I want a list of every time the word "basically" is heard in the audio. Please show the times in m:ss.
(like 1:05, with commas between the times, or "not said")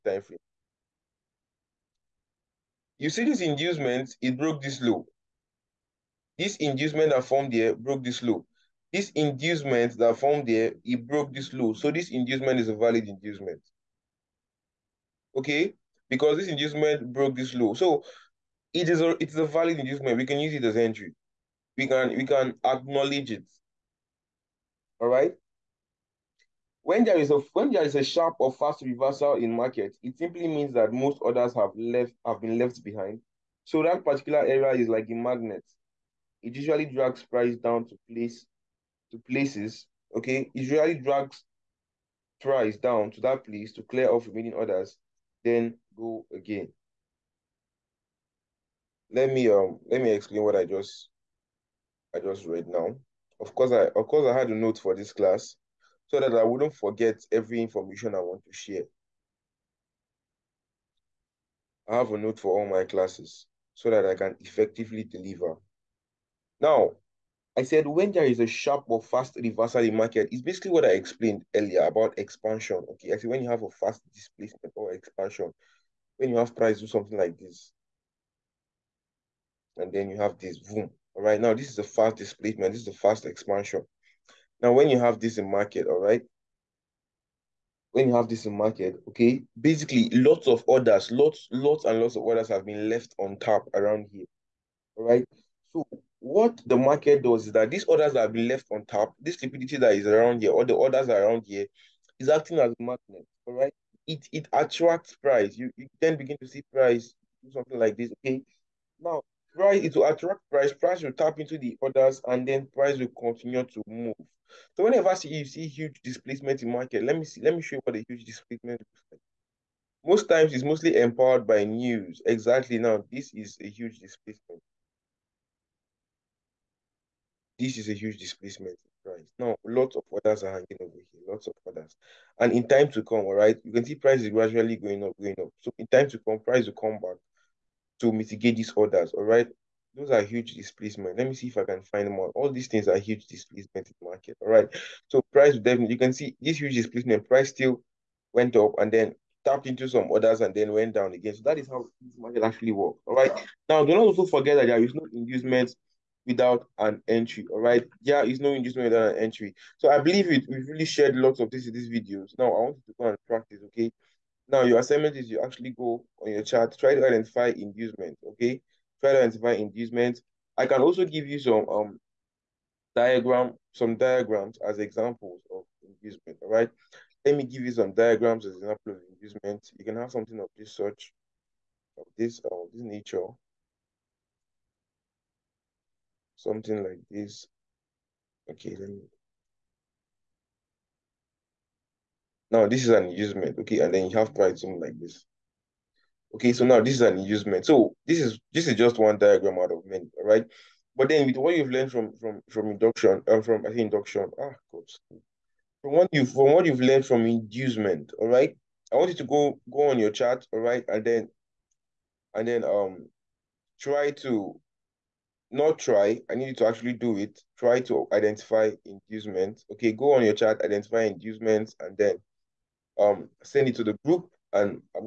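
1:10, 1:29.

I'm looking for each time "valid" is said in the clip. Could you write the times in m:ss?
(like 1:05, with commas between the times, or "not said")
0:12, 0:19.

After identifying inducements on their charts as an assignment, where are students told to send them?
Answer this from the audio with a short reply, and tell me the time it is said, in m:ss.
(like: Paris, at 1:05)
To the group, at 3:43.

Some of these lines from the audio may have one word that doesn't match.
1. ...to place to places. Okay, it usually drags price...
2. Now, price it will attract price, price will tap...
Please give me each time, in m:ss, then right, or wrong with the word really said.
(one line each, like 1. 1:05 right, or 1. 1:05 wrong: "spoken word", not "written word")
1. 0:37 right
2. 1:48 right.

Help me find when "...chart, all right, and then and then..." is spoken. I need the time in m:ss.
3:30.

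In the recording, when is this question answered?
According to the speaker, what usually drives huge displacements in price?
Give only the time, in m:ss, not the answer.
2:01.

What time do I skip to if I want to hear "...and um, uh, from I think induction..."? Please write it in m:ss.
3:23.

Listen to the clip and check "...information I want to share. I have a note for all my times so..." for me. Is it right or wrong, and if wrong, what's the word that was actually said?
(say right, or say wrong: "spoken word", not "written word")
wrong: "classes", not "times".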